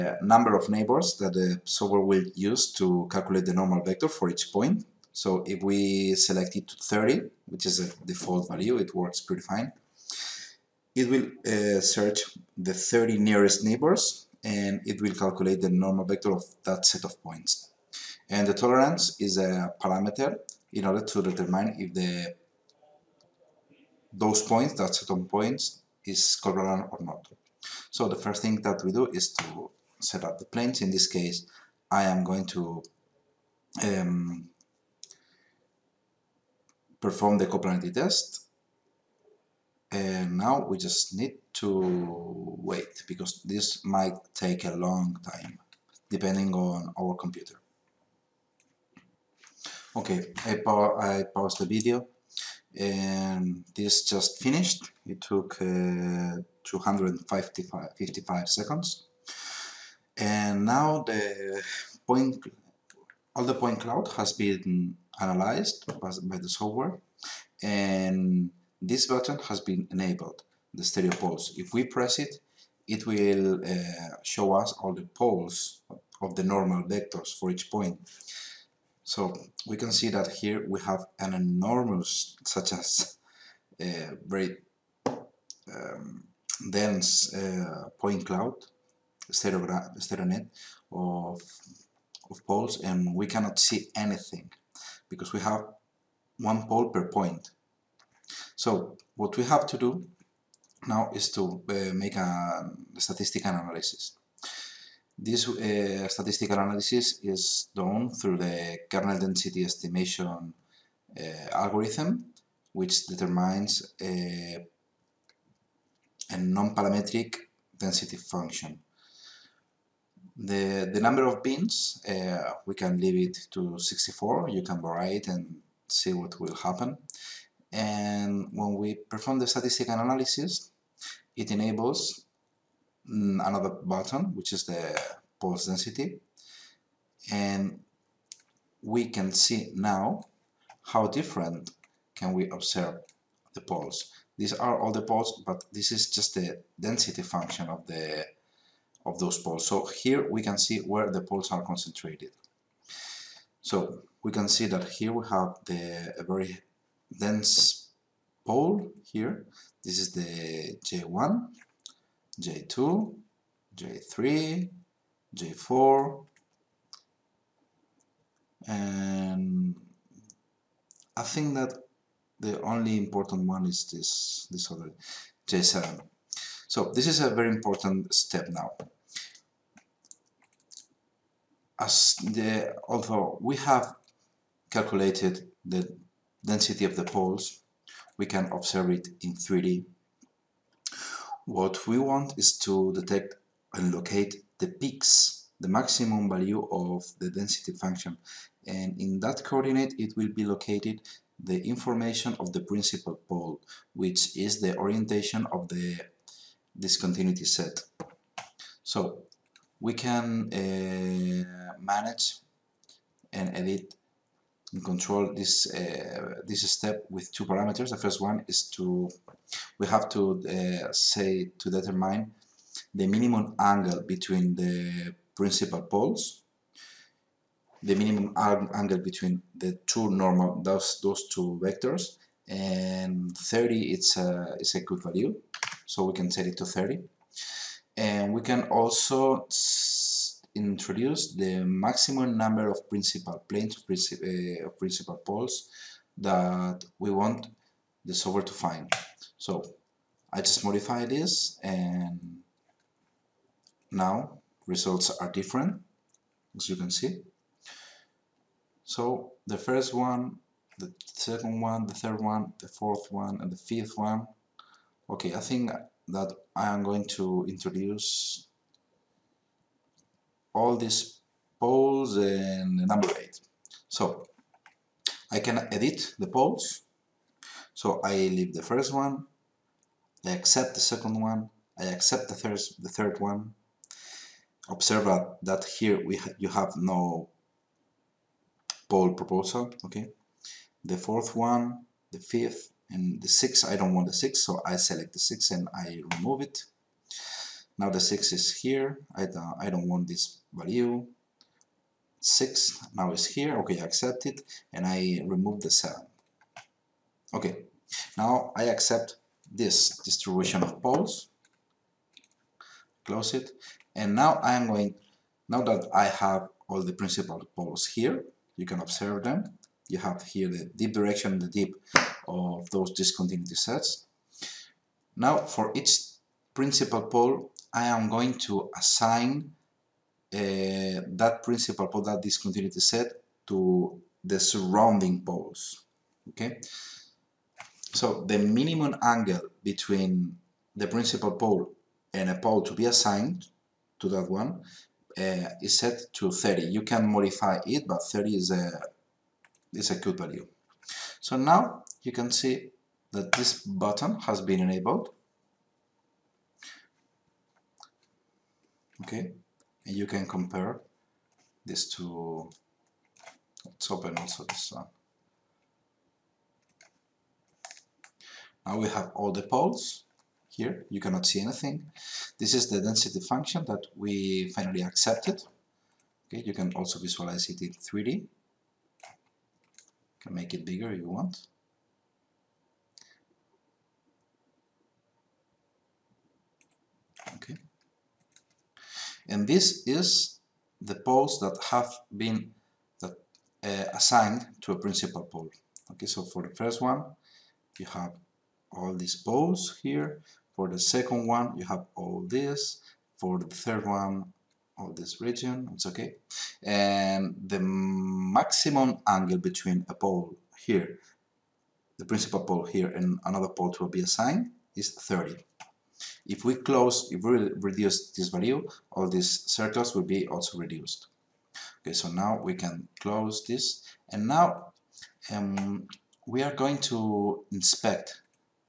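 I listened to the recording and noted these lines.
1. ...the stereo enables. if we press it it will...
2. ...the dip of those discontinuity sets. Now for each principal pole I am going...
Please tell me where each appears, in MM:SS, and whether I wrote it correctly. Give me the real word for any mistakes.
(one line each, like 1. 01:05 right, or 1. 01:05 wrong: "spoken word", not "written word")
1. 01:10 wrong: "poles", not "enables"
2. 05:21 right.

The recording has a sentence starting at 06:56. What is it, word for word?
If we close, if we reduce this value, all these circles will be also reduced.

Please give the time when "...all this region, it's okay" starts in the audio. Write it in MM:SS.
06:44.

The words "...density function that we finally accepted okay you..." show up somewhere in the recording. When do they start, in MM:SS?
06:12.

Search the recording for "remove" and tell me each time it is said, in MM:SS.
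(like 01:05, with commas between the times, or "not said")
04:56, 05:05.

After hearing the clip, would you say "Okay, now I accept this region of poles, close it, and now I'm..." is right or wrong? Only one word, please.
wrong.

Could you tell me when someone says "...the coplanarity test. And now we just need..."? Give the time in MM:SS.
00:37.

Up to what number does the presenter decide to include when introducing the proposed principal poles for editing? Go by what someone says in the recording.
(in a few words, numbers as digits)
8.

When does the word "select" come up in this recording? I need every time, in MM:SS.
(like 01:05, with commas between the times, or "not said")
00:06, 04:54.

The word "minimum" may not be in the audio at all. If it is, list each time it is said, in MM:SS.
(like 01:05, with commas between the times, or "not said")
03:43, 03:47, 05:38.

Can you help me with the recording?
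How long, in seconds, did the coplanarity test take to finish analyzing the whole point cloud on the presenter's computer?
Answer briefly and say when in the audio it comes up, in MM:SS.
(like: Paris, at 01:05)
255, at 00:56.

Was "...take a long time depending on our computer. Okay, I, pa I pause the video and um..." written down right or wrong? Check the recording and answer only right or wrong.
right.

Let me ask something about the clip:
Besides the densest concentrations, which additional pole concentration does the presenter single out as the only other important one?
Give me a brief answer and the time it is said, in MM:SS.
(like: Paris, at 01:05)
J7, at 02:55.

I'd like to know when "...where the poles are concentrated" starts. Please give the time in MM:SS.
02:30.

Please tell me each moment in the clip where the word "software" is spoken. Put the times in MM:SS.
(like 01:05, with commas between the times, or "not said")
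00:01, 01:06, 04:08.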